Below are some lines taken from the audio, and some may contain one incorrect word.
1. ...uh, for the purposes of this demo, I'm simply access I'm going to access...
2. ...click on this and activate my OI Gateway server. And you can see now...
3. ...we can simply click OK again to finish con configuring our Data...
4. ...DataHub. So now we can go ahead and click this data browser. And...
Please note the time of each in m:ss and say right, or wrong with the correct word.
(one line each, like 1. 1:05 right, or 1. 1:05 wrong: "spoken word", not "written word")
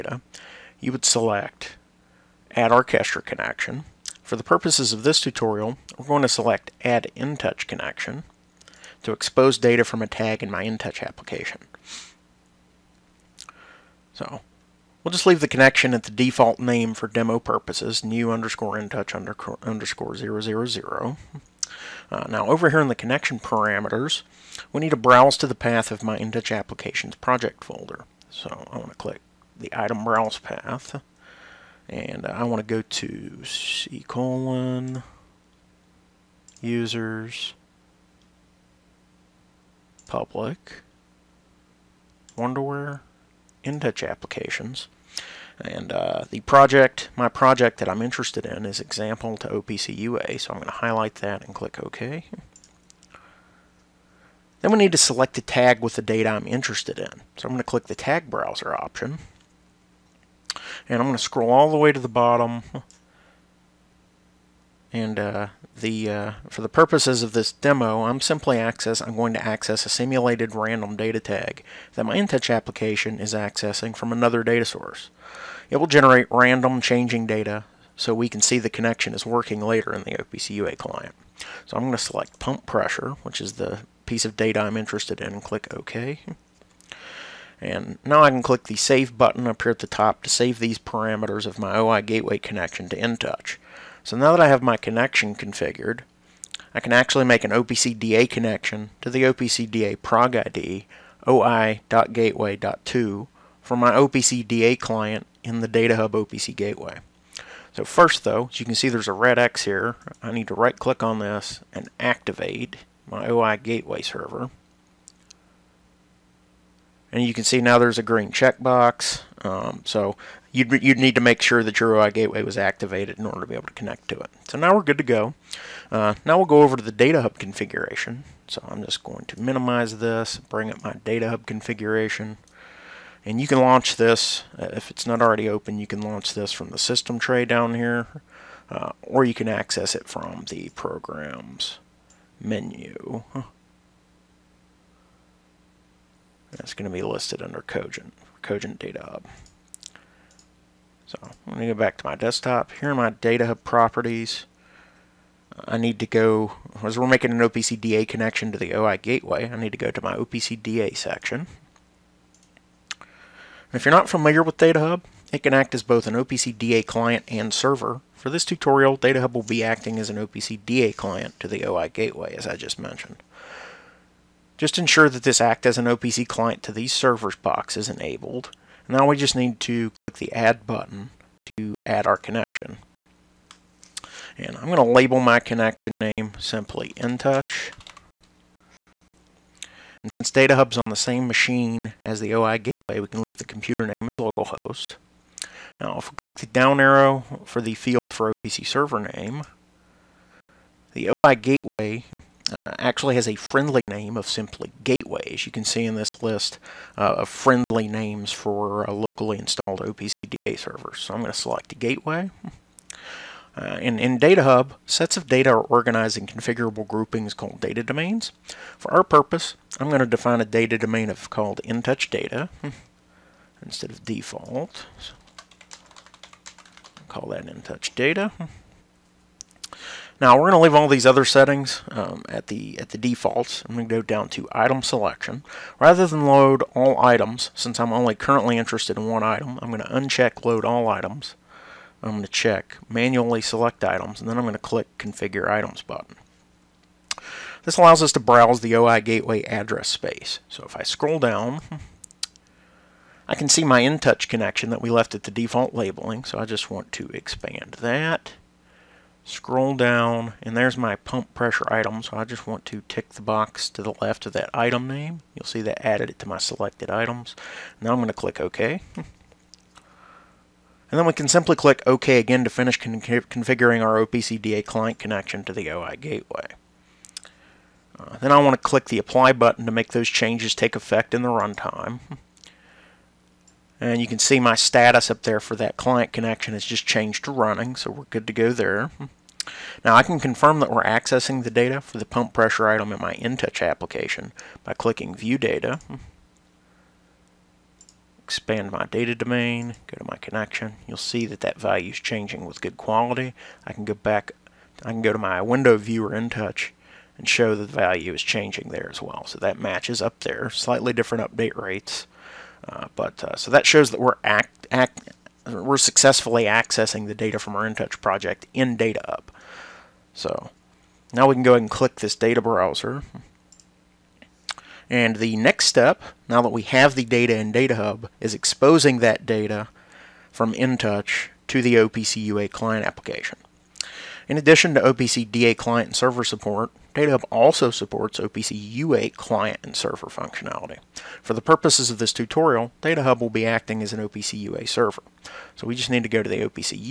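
1. 1:06 right
2. 1:50 right
3. 4:31 wrong: "OPCDA", not "Data"
4. 5:18 right.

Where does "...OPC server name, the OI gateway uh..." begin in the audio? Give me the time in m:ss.
3:18.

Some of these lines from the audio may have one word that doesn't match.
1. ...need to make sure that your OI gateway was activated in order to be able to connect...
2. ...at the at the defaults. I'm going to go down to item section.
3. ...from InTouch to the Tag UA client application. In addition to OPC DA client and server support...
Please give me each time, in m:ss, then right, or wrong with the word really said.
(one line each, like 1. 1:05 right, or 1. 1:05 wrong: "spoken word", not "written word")
1. 2:00 right
2. 3:52 wrong: "selection", not "section"
3. 5:30 wrong: "OPC", not "Tag".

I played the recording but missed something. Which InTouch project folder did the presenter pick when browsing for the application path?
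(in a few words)
example to OPC UA.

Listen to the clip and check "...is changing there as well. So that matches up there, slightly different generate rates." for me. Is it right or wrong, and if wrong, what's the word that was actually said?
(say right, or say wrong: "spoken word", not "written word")
wrong: "update", not "generate".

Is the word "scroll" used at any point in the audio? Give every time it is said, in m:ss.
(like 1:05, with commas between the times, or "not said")
1:01, 4:10, 4:19.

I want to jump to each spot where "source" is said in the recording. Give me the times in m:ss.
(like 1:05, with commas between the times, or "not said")
1:14.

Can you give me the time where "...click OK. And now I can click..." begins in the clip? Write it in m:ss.
1:25.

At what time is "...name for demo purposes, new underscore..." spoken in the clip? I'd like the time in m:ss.
0:16.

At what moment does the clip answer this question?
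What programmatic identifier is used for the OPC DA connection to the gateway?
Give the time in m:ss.
1:41.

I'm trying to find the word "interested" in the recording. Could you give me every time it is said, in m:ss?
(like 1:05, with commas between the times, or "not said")
0:48, 0:56, 1:24, 3:58.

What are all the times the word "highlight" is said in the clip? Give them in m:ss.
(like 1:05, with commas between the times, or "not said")
0:50.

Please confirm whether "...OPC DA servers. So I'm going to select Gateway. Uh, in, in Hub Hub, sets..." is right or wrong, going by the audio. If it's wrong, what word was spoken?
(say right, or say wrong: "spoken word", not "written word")
wrong: "Data", not "Hub".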